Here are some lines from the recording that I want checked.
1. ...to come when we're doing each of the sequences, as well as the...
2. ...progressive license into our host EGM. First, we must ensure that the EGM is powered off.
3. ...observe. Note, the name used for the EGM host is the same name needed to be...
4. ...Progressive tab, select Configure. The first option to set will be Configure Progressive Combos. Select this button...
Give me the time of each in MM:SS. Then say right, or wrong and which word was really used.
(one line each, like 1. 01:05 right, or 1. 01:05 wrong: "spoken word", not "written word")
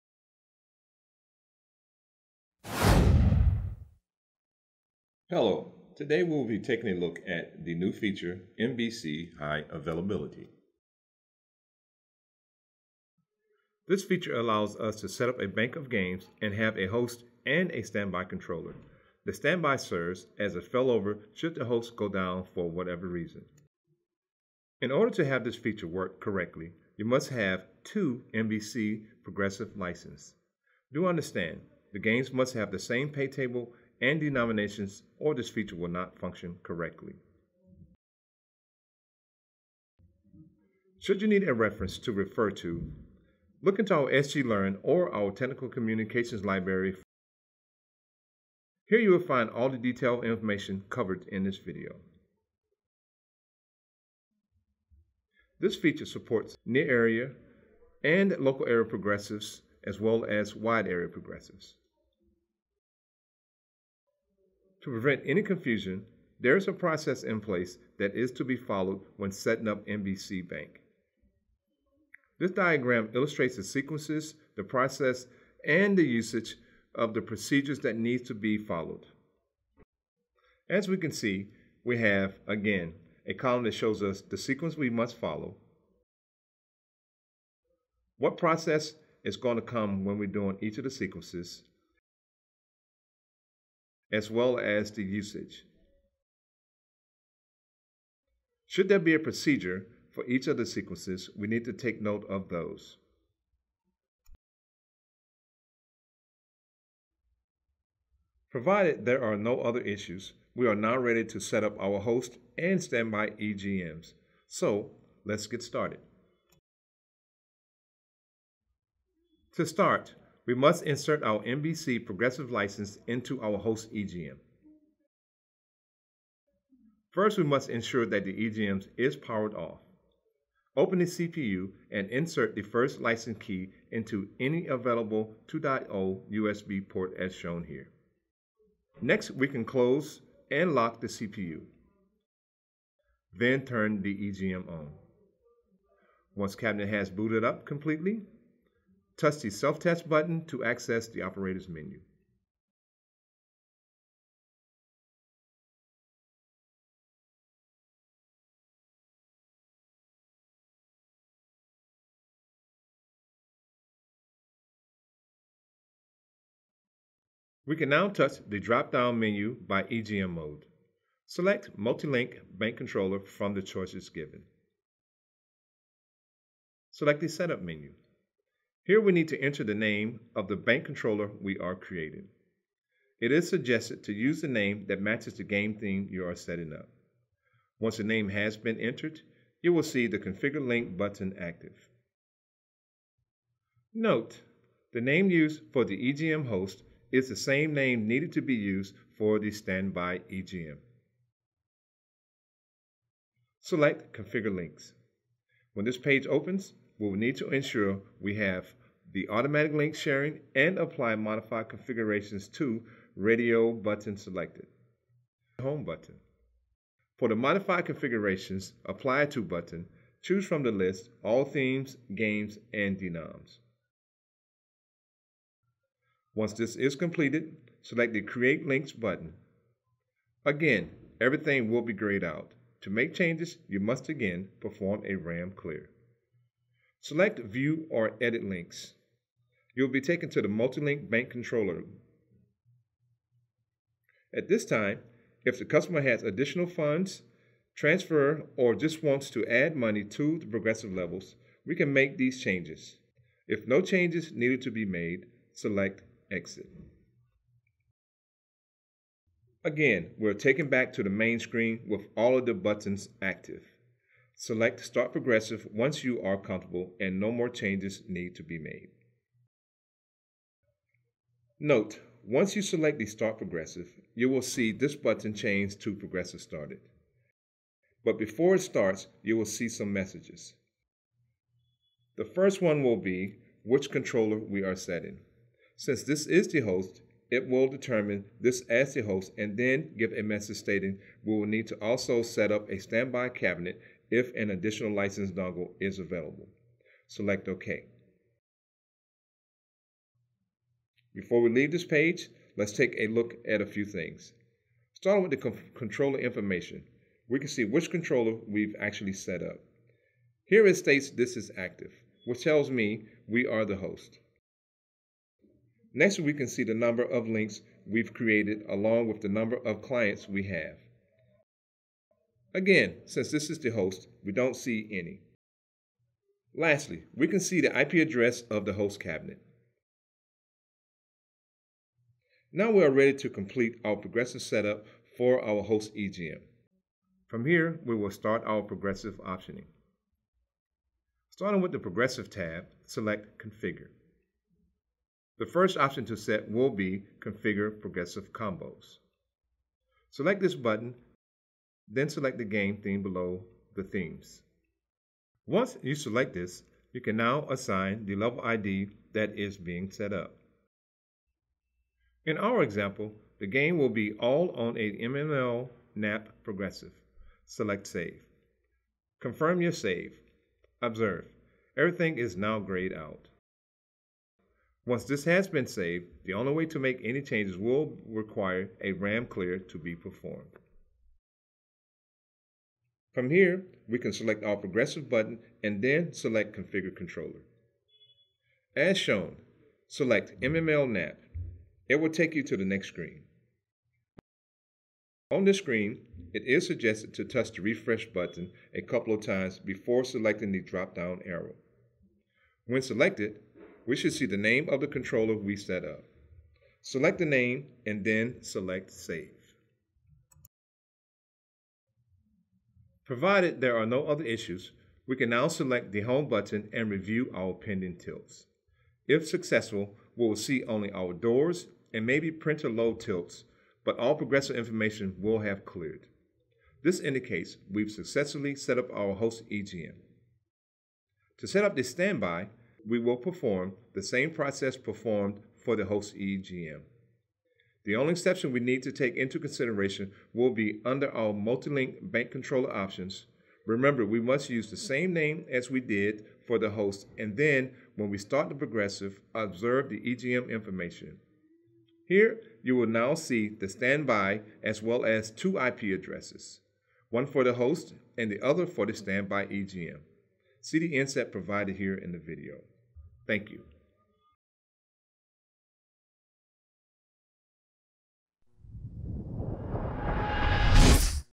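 1. 01:29 right
2. 02:02 right
3. 03:11 wrong: "active", not "observe"
4. 05:41 right.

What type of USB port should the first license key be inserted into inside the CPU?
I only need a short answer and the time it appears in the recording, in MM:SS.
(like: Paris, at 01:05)
USB 2.0, at 02:15.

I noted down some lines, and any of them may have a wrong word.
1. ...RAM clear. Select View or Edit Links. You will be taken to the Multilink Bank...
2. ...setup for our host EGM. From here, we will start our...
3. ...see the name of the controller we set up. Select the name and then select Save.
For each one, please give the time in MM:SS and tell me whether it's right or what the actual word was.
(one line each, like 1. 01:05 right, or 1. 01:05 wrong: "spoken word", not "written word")
1. 03:55 right
2. 05:34 right
3. 06:44 right.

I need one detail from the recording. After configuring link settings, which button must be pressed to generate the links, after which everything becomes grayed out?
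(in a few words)
Create Links.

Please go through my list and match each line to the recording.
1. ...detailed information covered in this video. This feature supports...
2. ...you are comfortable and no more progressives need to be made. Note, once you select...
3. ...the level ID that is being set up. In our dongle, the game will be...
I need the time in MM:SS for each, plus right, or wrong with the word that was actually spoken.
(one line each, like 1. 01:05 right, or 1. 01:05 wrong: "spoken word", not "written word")
1. 00:49 right
2. 04:26 wrong: "changes", not "progressives"
3. 05:58 wrong: "example", not "dongle".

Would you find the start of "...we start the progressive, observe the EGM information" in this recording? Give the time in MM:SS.
07:28.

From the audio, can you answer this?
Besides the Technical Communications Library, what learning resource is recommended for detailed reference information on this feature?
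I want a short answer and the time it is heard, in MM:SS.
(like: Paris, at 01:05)
SGLearn, at 00:44.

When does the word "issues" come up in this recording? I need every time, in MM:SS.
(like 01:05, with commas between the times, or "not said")
01:49, 06:54.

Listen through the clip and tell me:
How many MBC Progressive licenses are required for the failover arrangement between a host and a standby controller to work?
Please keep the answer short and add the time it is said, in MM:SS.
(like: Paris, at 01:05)
2, at 00:27.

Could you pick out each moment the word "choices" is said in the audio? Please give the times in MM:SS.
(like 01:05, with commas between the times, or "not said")
02:53.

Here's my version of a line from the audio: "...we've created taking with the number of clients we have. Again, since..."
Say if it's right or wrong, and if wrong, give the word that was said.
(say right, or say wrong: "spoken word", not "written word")
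wrong: "along", not "taking".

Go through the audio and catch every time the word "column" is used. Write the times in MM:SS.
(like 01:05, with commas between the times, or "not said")
01:23.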